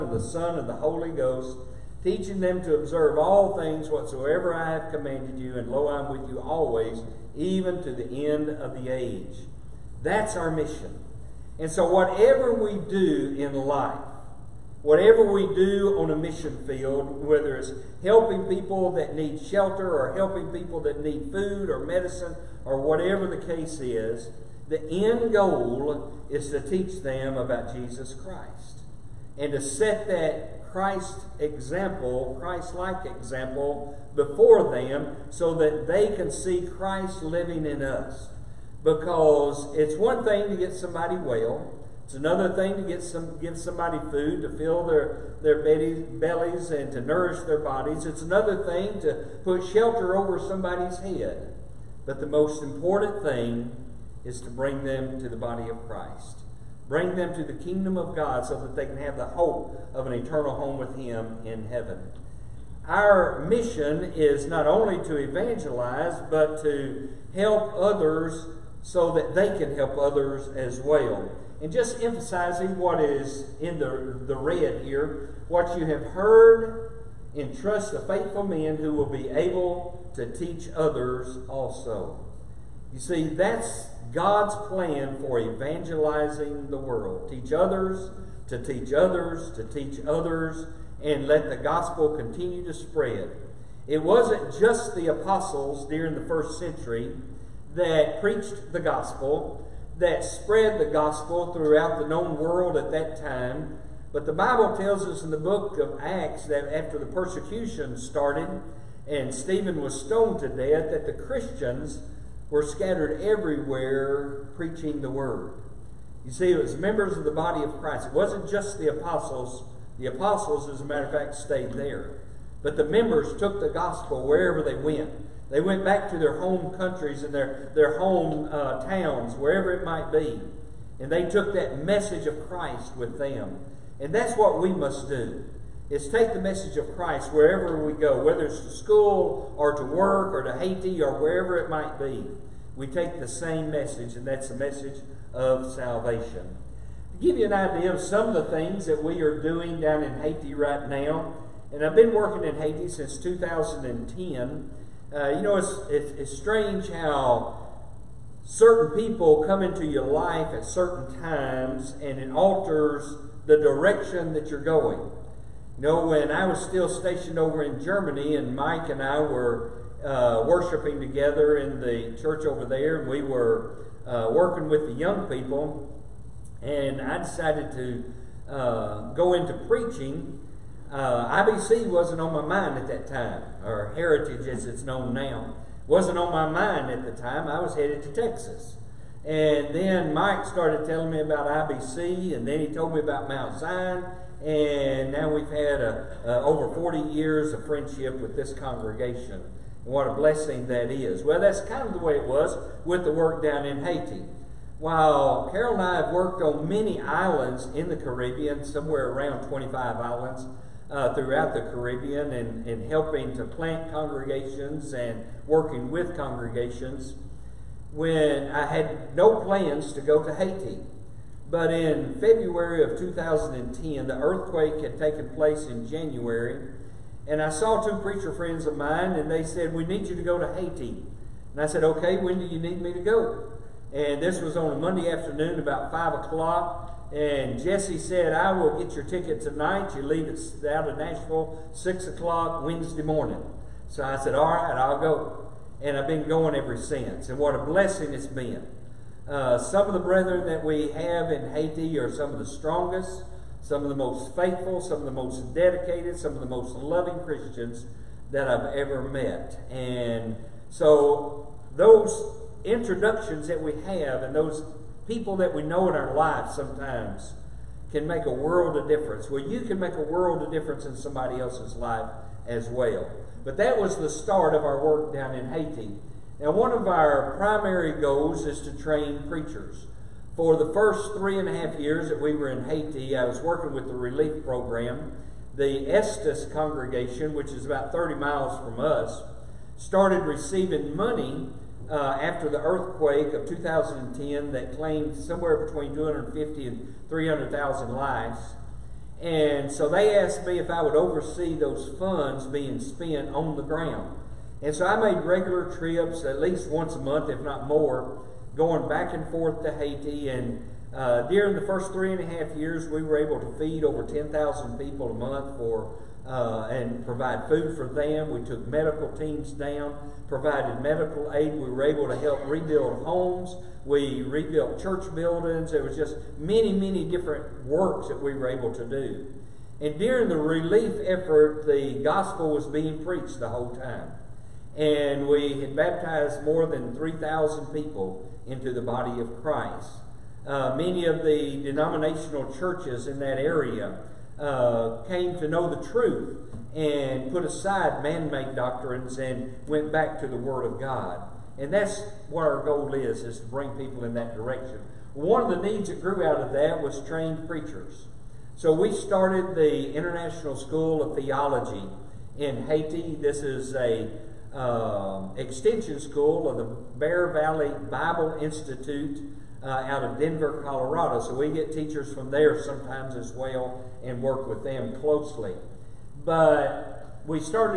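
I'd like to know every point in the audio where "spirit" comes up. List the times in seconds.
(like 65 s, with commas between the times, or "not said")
not said.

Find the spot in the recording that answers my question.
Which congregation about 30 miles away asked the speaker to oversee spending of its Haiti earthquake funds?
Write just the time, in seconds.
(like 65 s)
285 s.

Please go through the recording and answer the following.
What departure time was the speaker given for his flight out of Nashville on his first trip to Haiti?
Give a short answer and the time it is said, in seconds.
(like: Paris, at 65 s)
6 o'clock Wednesday morning, at 241 s.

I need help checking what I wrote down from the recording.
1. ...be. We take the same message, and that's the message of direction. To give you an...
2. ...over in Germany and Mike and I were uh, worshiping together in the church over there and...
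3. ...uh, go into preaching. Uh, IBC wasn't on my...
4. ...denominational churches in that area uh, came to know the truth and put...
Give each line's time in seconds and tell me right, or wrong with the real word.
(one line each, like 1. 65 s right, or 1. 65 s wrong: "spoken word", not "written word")
1. 141 s wrong: "salvation", not "direction"
2. 167 s right
3. 178 s right
4. 341 s right.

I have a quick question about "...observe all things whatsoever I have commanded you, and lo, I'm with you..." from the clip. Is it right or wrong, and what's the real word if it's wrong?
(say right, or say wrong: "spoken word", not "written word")
right.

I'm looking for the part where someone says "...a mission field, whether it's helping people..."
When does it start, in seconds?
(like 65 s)
16 s.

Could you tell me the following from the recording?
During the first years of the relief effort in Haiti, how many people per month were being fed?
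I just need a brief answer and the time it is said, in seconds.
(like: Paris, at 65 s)
over 10,000, at 313 s.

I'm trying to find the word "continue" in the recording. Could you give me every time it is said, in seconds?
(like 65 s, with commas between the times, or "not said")
92 s.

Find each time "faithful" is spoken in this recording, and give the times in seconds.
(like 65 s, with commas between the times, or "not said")
78 s, 254 s.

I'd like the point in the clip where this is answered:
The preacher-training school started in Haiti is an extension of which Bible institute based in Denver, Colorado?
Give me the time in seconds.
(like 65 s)
366 s.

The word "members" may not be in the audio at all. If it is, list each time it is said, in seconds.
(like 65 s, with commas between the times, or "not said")
116 s, 122 s.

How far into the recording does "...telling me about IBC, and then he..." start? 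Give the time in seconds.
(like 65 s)
190 s.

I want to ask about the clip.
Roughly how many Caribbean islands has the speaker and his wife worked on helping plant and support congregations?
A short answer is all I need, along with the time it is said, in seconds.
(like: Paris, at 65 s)
25, at 209 s.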